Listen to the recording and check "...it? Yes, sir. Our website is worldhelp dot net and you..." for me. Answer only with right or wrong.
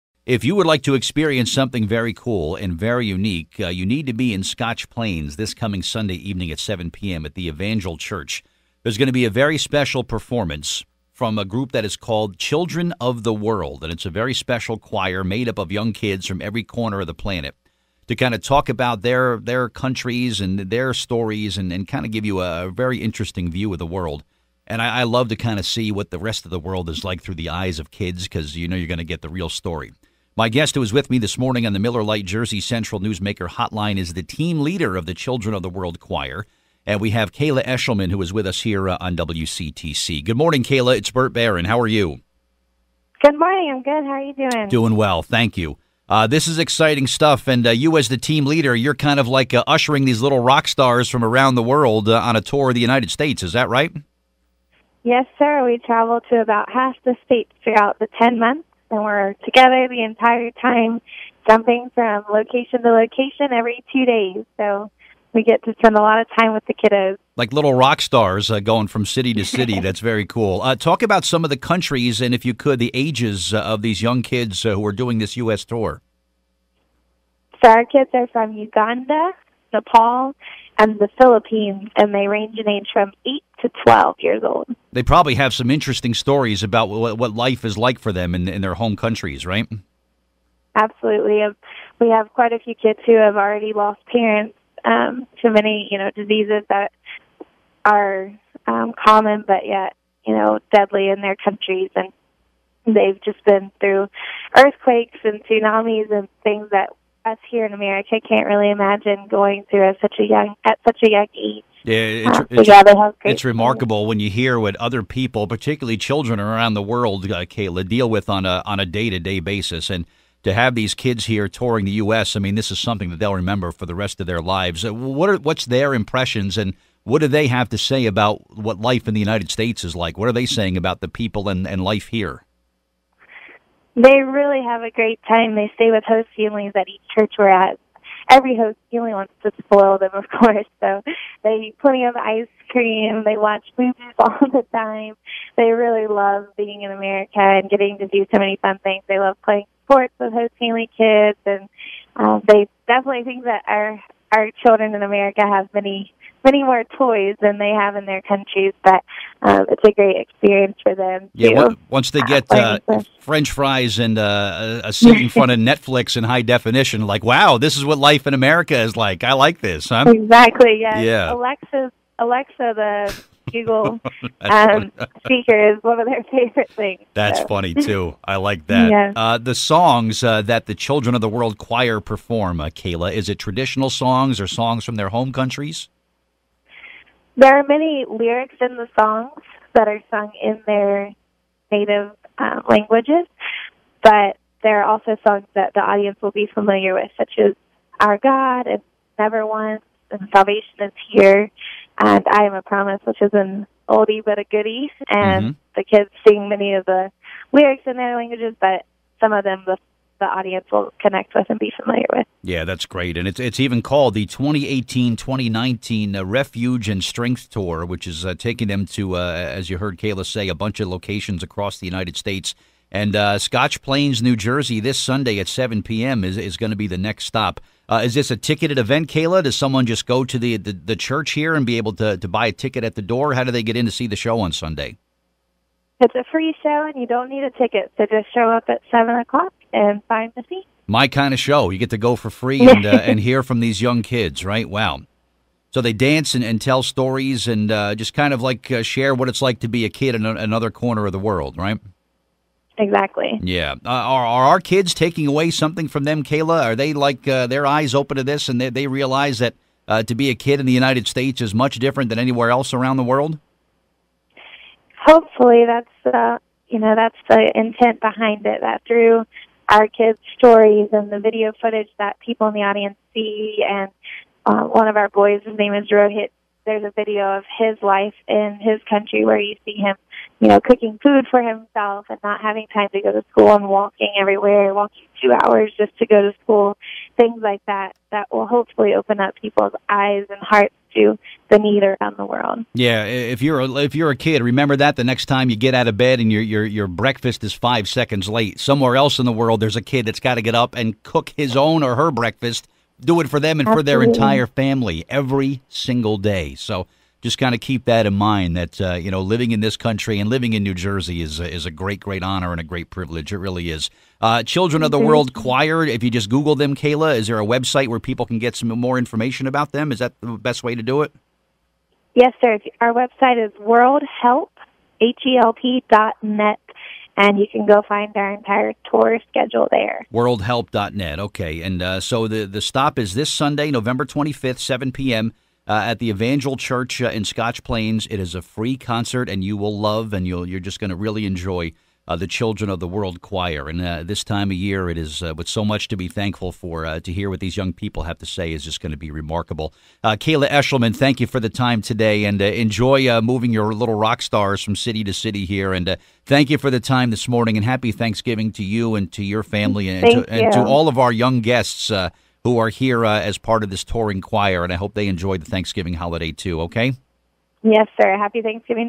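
right.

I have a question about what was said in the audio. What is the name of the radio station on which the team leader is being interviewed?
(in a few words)
WCTC.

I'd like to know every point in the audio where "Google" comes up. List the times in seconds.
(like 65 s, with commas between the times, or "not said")
173 s, 316 s.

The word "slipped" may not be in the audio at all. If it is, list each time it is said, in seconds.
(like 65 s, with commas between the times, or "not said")
not said.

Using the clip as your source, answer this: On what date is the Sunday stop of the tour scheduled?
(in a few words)
November 25th.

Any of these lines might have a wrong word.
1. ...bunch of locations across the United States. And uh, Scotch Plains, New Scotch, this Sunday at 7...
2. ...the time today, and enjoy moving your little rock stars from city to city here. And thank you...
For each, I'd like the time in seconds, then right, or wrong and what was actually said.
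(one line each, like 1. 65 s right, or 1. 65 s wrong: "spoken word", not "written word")
1. 220 s wrong: "Jersey", not "Scotch"
2. 351 s right.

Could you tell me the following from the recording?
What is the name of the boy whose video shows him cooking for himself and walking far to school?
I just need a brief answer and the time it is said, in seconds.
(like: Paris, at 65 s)
Rohit, at 275 s.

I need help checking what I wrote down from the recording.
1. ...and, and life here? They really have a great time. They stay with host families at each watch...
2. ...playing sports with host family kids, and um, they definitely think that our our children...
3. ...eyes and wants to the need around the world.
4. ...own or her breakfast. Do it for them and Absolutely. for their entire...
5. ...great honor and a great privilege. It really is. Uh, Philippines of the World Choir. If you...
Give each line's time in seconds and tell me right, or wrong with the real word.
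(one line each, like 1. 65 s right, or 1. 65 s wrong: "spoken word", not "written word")
1. 131 s wrong: "church", not "watch"
2. 149 s right
3. 289 s wrong: "hearts", not "wants"
4. 301 s right
5. 311 s wrong: "Children", not "Philippines".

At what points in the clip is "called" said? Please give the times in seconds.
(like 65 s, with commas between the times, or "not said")
11 s, 213 s.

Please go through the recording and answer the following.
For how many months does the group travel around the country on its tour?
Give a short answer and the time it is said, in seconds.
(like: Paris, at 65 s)
10, at 58 s.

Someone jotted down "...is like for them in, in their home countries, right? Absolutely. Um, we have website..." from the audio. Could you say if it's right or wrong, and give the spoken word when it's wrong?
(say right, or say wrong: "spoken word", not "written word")
wrong: "quite", not "website".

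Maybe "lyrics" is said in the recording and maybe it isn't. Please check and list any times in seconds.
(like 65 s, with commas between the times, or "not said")
188 s, 207 s.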